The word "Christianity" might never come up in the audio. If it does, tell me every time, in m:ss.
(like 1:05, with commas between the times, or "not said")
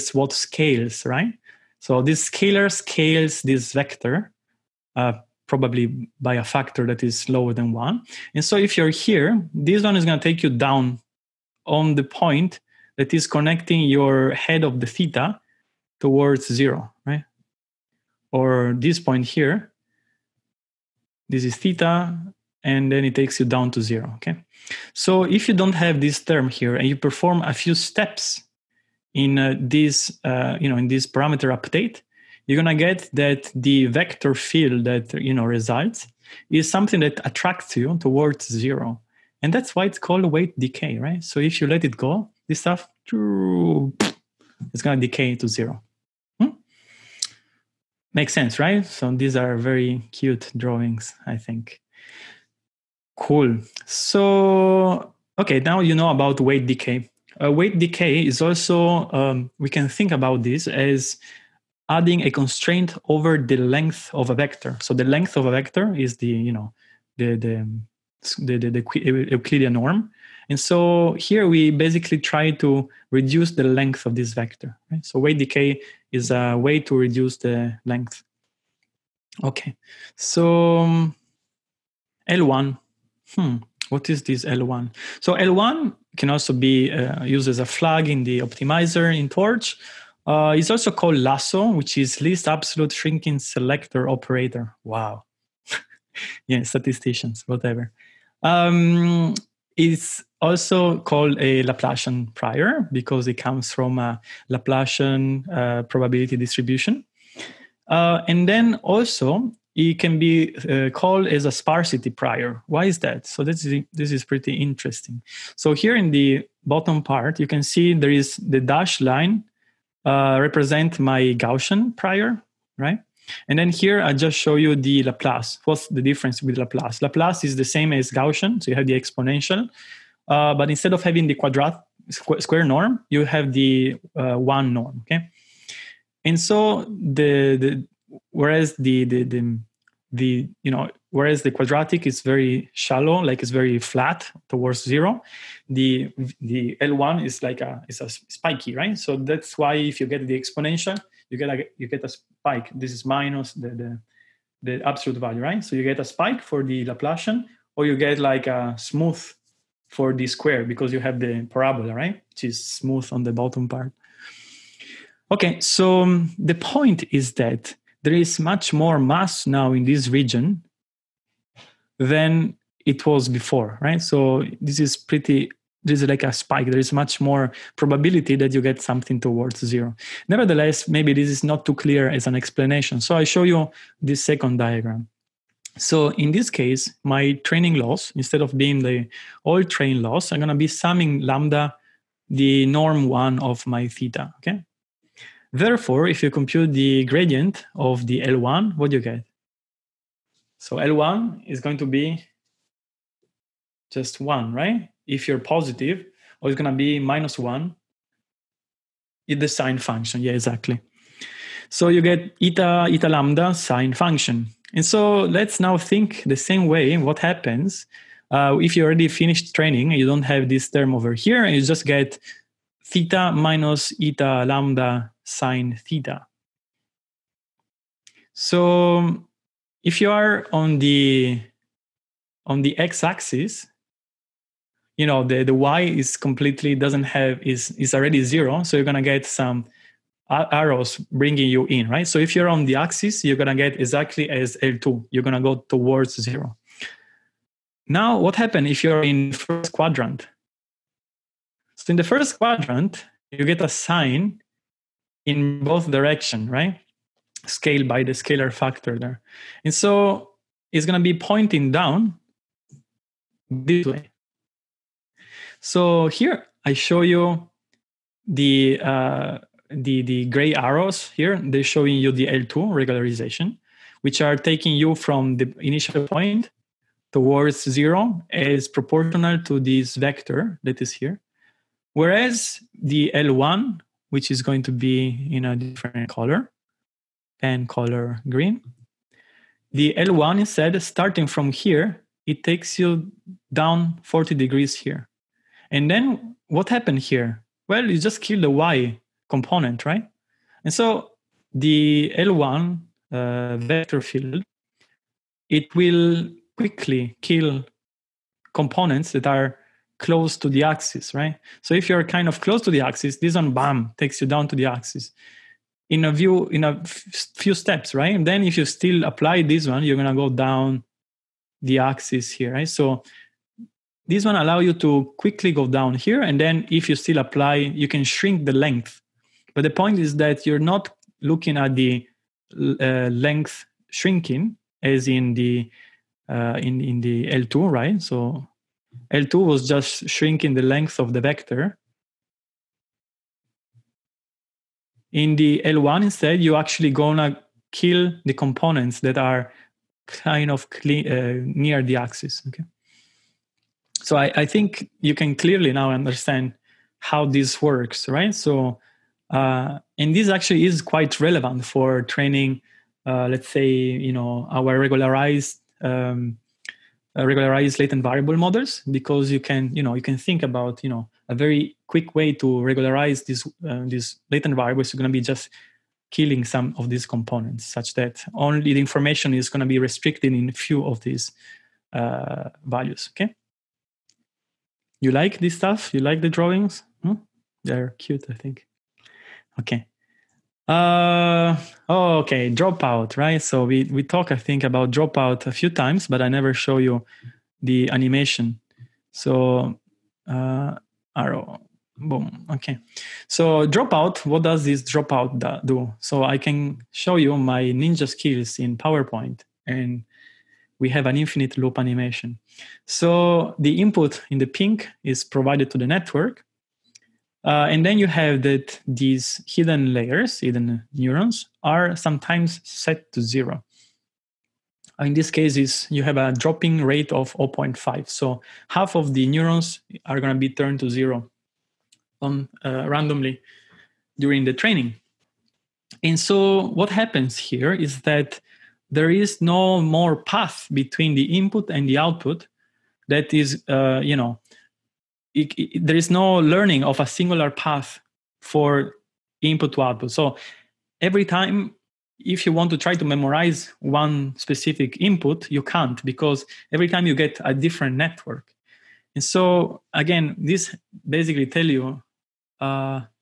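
not said.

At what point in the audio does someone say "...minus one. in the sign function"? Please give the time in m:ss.
3:26.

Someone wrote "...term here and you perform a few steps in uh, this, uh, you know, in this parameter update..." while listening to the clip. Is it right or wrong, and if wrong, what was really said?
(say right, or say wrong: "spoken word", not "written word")
right.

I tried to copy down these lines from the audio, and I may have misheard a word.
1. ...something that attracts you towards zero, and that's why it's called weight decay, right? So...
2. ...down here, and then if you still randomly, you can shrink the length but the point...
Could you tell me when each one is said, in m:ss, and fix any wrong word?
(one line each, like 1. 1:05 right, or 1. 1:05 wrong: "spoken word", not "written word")
1. 0:36 right
2. 5:25 wrong: "apply", not "randomly".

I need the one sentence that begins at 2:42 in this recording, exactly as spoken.
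Which is smooth on the bottom part.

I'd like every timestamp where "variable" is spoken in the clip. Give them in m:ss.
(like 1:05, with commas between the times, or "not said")
6:08, 6:14.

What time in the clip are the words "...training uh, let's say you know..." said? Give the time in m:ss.
6:02.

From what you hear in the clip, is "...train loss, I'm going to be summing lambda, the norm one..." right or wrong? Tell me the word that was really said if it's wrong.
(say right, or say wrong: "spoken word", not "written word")
right.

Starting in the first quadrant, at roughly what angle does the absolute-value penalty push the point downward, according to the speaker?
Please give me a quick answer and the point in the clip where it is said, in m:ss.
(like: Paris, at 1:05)
40 degrees, at 4:54.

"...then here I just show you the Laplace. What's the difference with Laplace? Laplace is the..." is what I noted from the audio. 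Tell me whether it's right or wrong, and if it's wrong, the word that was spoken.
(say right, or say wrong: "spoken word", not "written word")
right.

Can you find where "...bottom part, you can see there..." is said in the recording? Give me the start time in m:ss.
1:56.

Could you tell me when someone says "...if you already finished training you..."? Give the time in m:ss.
3:38.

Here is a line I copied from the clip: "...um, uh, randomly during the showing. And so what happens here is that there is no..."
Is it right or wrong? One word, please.
wrong.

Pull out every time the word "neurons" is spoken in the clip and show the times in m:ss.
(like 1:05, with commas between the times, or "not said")
7:00, 7:09.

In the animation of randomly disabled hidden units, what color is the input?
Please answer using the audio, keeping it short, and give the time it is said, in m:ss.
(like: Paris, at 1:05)
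pink, at 6:54.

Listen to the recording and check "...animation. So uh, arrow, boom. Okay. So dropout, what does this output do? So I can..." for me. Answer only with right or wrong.
wrong.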